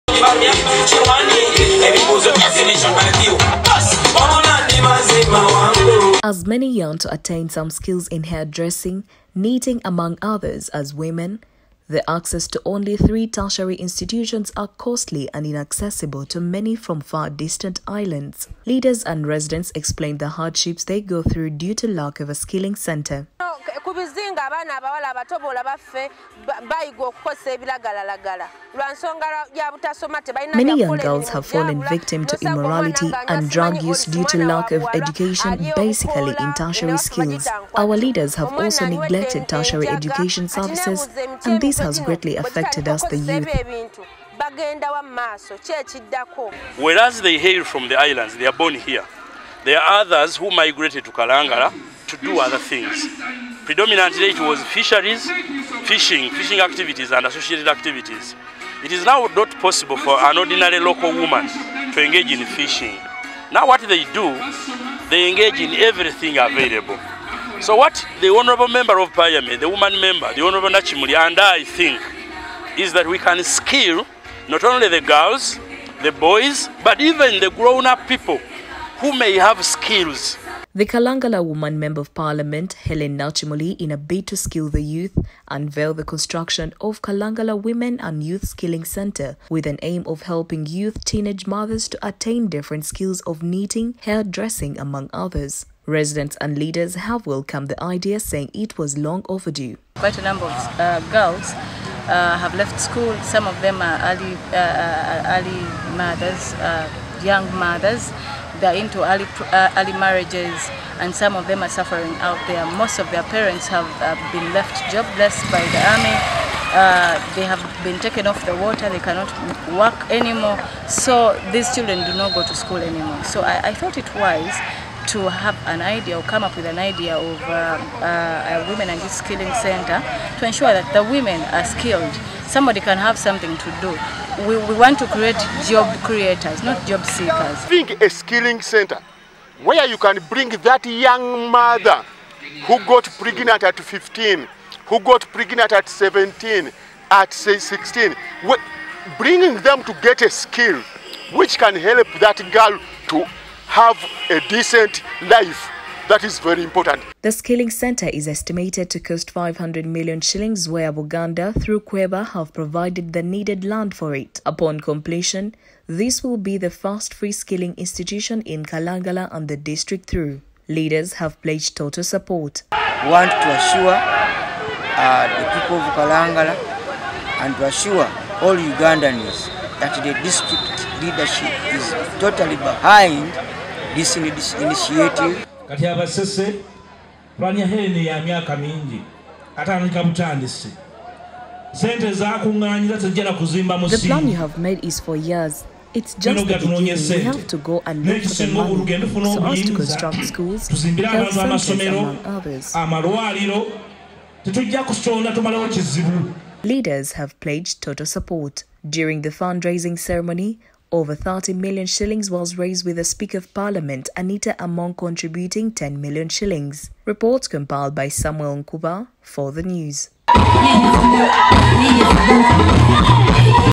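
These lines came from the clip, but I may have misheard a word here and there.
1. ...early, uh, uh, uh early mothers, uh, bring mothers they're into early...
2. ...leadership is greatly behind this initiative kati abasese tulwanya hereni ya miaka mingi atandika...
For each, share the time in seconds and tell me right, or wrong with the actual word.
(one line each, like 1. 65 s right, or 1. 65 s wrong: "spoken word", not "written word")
1. 104 s wrong: "young", not "bring"
2. 181 s wrong: "totally", not "greatly".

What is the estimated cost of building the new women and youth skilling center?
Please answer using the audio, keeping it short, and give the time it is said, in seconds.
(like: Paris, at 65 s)
500 million shillings, at 159 s.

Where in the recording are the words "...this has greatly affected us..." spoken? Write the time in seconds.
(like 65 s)
41 s.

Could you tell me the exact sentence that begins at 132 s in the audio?
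Somebody can have something to do.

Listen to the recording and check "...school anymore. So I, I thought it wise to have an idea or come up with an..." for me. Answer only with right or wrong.
right.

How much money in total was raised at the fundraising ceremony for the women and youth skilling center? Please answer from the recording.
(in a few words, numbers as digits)
Over 30 million shillings.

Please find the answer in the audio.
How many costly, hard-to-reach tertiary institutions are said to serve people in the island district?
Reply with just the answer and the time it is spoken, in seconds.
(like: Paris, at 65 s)
3, at 12 s.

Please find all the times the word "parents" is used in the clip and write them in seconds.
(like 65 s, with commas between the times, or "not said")
113 s.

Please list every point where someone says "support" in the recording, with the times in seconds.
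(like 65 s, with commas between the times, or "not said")
172 s, 208 s.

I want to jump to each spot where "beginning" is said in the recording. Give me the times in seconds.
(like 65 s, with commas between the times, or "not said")
196 s.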